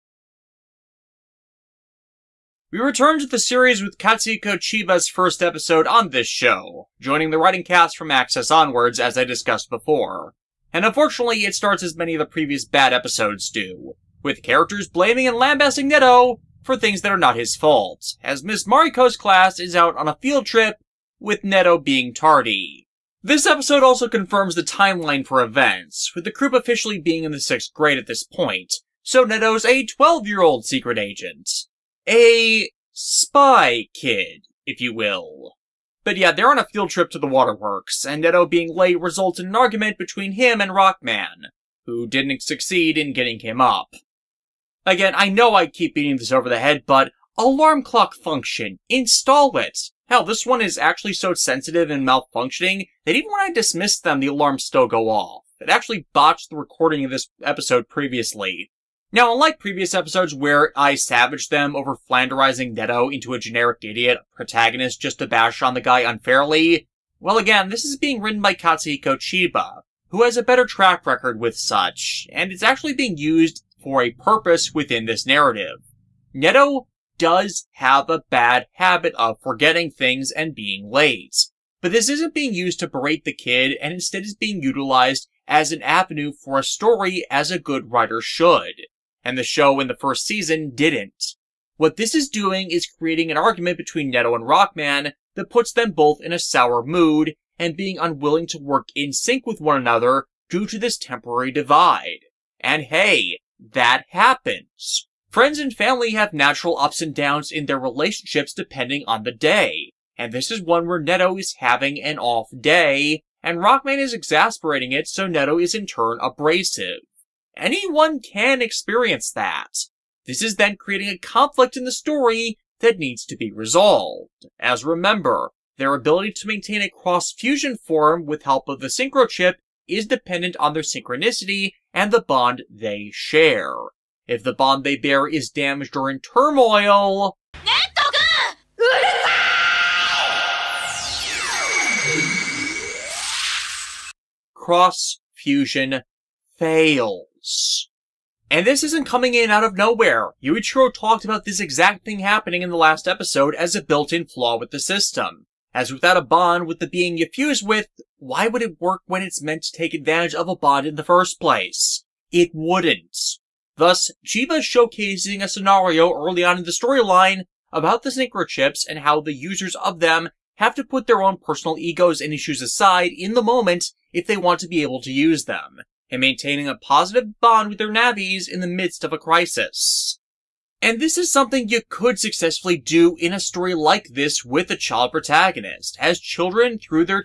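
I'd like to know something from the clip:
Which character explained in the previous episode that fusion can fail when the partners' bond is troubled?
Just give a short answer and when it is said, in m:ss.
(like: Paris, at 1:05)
Yuichiro, at 2:30.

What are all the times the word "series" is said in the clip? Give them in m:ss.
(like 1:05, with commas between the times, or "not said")
0:03.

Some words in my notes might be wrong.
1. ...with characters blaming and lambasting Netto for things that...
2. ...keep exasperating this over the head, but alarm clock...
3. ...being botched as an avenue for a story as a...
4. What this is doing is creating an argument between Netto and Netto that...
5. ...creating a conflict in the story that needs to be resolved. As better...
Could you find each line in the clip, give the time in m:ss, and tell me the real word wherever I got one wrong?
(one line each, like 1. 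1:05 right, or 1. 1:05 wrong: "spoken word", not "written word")
1. 0:14 right
2. 0:45 wrong: "beating", not "exasperating"
3. 1:24 wrong: "utilized", not "botched"
4. 1:31 wrong: "Rockman", not "Netto"
5. 2:00 wrong: "remember", not "better".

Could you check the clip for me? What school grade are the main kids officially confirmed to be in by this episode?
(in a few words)
6th grade.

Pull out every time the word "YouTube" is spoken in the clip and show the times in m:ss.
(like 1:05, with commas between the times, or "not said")
not said.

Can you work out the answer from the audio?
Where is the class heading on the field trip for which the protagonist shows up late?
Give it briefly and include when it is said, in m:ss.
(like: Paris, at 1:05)
the waterworks, at 0:37.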